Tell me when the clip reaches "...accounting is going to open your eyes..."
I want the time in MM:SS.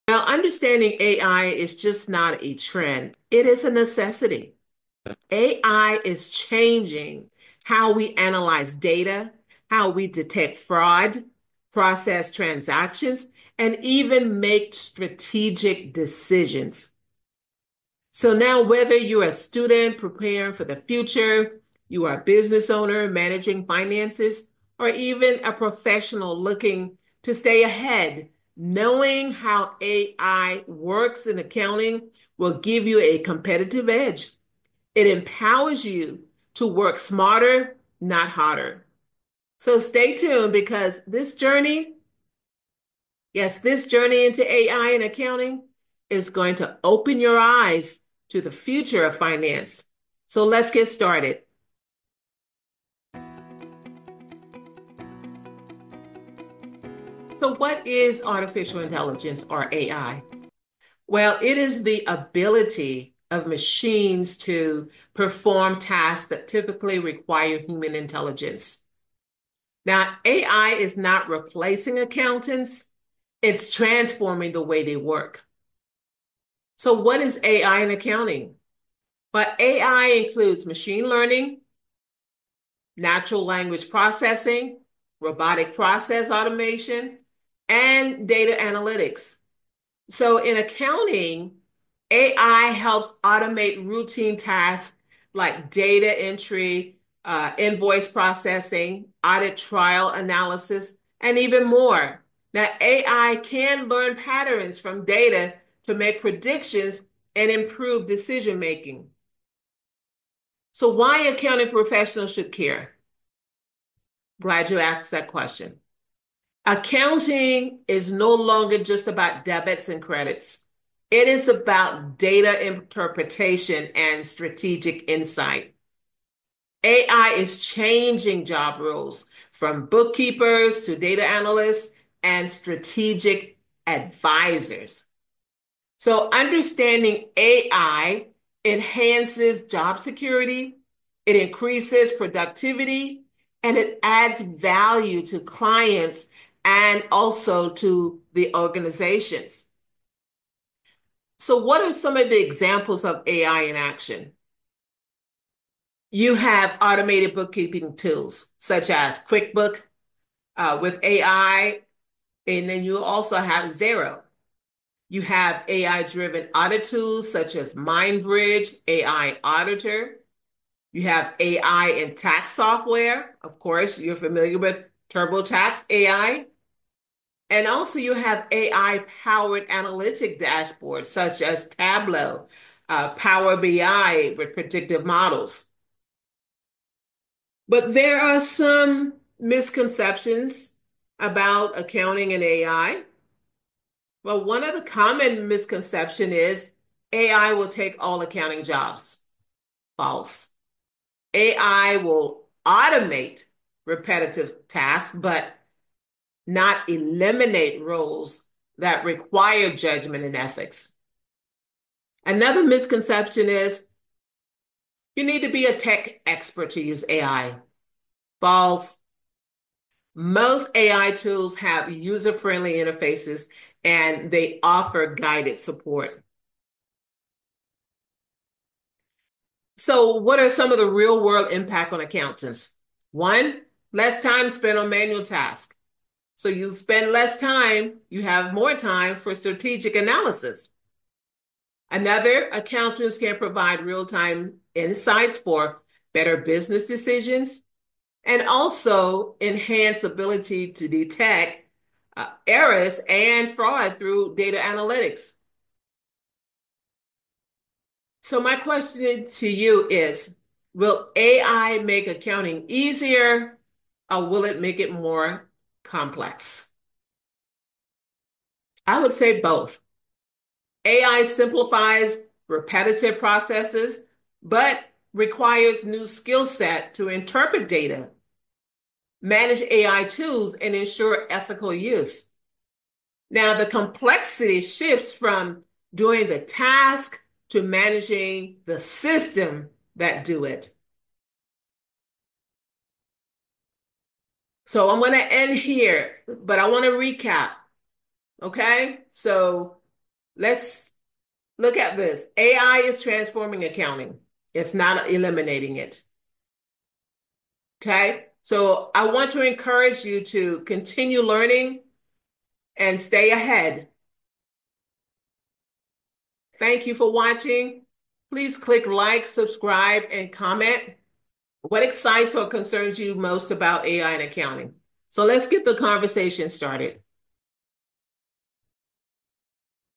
00:45.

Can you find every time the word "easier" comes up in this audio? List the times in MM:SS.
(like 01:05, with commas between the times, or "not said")
04:22.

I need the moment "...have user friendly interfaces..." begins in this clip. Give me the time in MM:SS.
03:41.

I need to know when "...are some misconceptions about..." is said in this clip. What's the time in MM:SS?
03:08.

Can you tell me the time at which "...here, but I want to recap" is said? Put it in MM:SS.
04:55.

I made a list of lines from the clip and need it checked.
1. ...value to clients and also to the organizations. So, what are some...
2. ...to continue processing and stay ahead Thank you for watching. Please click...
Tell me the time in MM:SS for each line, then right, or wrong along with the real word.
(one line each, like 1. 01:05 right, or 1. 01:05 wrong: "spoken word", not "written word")
1. 02:24 right
2. 05:10 wrong: "learning", not "processing".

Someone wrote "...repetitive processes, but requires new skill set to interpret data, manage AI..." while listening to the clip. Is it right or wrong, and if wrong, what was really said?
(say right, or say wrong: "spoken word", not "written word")
right.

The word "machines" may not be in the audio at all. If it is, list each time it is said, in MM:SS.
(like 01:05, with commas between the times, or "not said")
01:03, 01:20.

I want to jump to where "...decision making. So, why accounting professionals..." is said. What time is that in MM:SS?
01:48.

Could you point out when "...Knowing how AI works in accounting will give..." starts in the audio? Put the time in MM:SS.
00:28.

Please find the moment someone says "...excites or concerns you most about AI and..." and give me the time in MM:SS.
05:21.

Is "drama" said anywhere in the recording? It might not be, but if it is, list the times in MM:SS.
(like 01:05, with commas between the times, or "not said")
not said.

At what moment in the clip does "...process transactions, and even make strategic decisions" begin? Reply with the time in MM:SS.
00:11.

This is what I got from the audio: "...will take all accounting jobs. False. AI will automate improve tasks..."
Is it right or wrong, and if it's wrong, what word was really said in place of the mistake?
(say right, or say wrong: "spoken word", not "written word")
wrong: "repetitive", not "improve".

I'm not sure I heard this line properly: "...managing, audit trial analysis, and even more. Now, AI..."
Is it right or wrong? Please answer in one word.
wrong.